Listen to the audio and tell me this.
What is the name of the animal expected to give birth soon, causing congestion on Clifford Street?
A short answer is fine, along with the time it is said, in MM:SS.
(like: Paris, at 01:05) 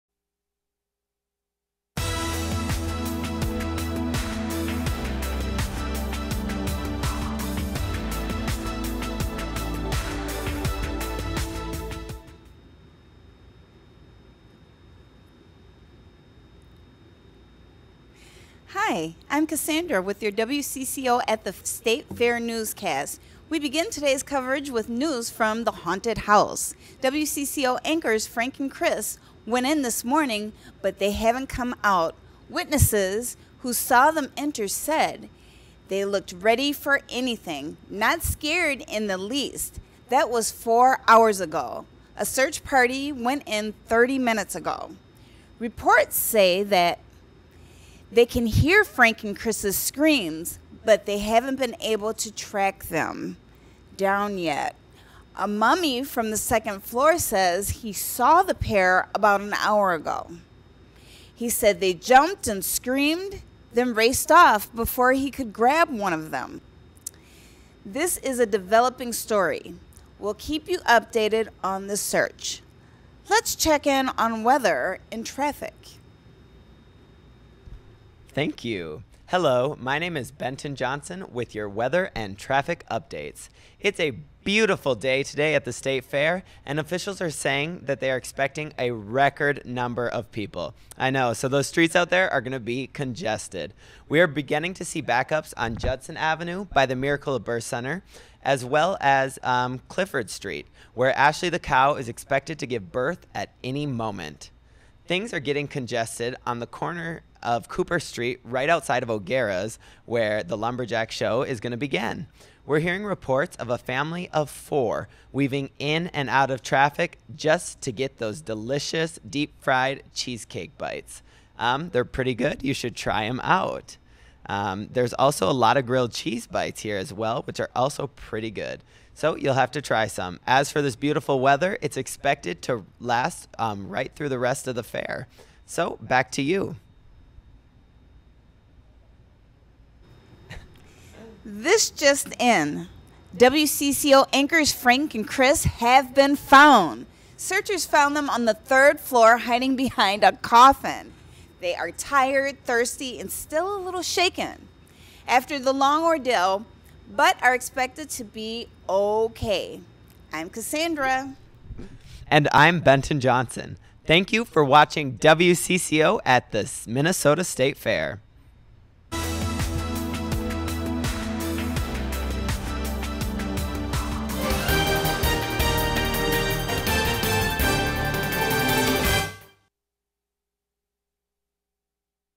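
Ashley, at 01:41.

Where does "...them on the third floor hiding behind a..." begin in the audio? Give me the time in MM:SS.
02:28.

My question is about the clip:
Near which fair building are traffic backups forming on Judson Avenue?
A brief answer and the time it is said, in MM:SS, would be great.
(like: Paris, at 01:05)
Miracle of Birth Center, at 01:36.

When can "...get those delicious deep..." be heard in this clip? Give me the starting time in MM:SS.
01:57.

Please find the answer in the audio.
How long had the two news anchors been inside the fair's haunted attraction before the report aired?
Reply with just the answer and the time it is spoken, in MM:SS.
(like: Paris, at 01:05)
4 hours, at 00:40.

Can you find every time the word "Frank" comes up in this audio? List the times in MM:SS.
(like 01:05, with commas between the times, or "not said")
00:28, 00:48, 02:24.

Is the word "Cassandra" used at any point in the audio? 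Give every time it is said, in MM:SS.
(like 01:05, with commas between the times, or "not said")
00:19, 02:40.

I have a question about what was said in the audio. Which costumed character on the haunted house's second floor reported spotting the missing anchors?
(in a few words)
A mummy.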